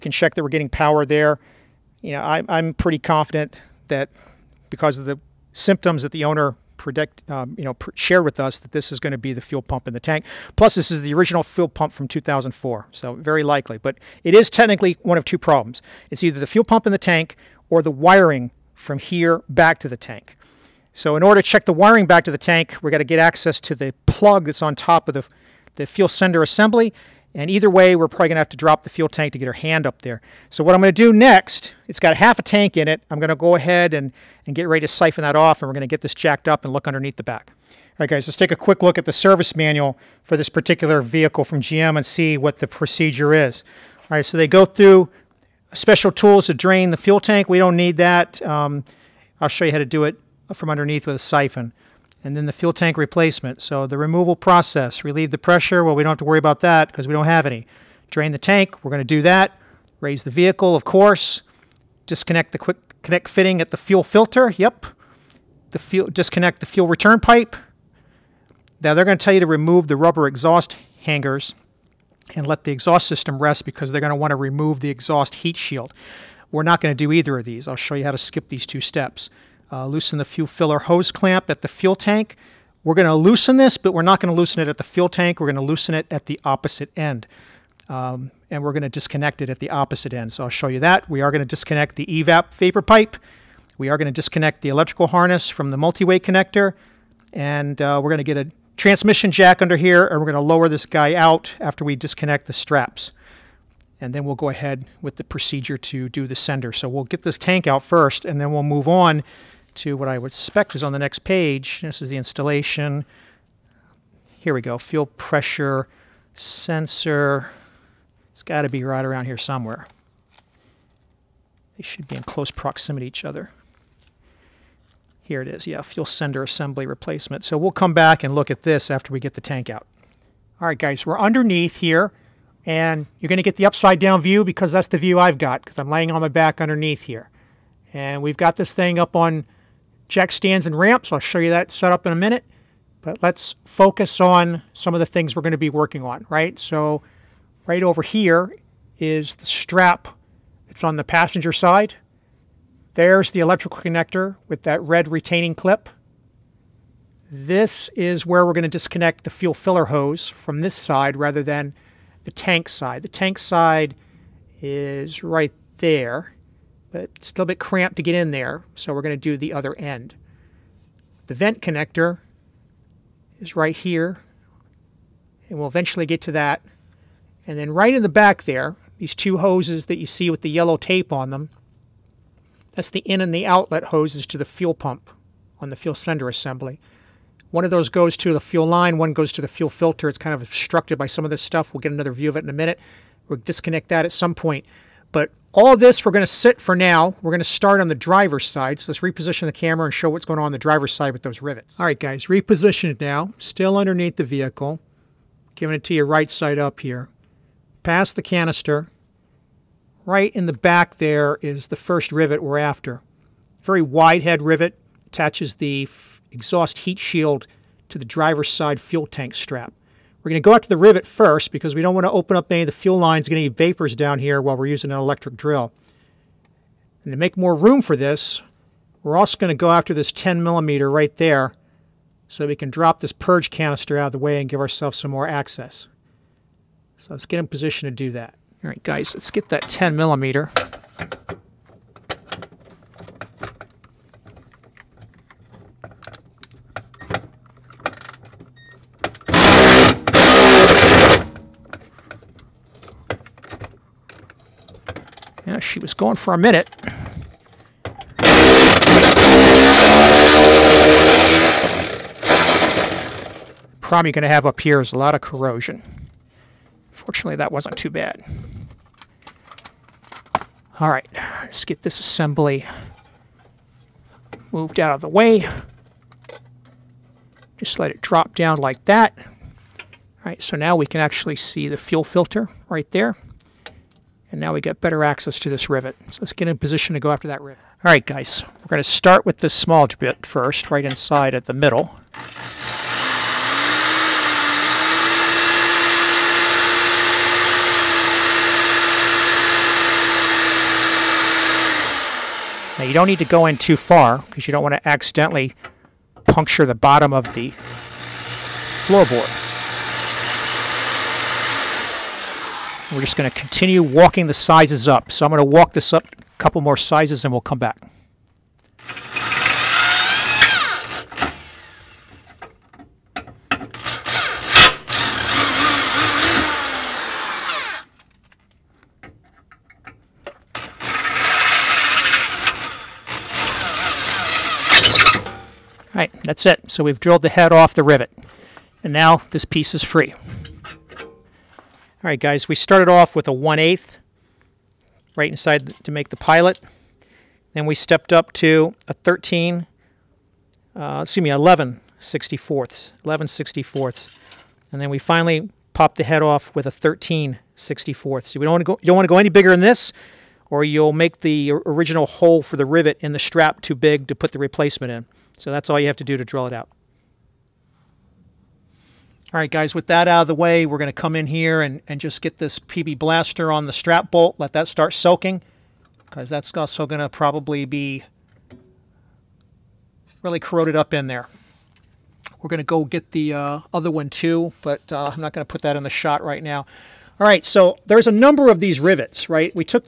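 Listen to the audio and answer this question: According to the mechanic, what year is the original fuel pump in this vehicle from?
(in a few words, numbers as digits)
2004.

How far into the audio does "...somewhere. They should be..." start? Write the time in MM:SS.
01:59.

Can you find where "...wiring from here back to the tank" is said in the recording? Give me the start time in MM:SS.
00:17.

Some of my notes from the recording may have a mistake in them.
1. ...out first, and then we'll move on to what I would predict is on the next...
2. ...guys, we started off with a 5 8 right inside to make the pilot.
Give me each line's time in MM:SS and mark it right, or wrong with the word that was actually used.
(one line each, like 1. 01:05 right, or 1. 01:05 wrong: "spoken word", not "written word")
1. 01:47 wrong: "expect", not "predict"
2. 05:42 wrong: "1", not "5".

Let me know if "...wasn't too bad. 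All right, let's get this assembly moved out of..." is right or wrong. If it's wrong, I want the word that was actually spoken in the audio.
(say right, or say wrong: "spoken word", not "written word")
right.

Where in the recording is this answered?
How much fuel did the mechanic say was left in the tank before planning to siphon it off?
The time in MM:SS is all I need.
00:32.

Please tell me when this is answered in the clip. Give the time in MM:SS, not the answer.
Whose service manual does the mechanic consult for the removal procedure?
00:41.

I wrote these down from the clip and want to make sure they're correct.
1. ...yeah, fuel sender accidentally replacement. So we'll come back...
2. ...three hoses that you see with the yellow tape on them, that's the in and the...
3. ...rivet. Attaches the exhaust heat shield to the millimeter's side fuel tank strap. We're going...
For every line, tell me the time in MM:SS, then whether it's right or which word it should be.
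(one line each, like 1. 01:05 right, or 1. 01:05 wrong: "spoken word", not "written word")
1. 02:05 wrong: "assembly", not "accidentally"
2. 02:59 wrong: "two", not "three"
3. 03:34 wrong: "driver", not "millimeter".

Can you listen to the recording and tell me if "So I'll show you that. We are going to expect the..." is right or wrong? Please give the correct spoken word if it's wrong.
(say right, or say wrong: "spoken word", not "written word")
wrong: "disconnect", not "expect".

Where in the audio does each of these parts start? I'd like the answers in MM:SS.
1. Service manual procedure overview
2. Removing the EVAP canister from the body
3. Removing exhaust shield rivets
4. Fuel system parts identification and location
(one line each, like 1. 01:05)
1. 00:37
2. 03:58
3. 04:45
4. 02:10.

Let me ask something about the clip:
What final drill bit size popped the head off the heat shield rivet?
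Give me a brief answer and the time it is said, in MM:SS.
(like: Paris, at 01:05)
13/64, at 05:56.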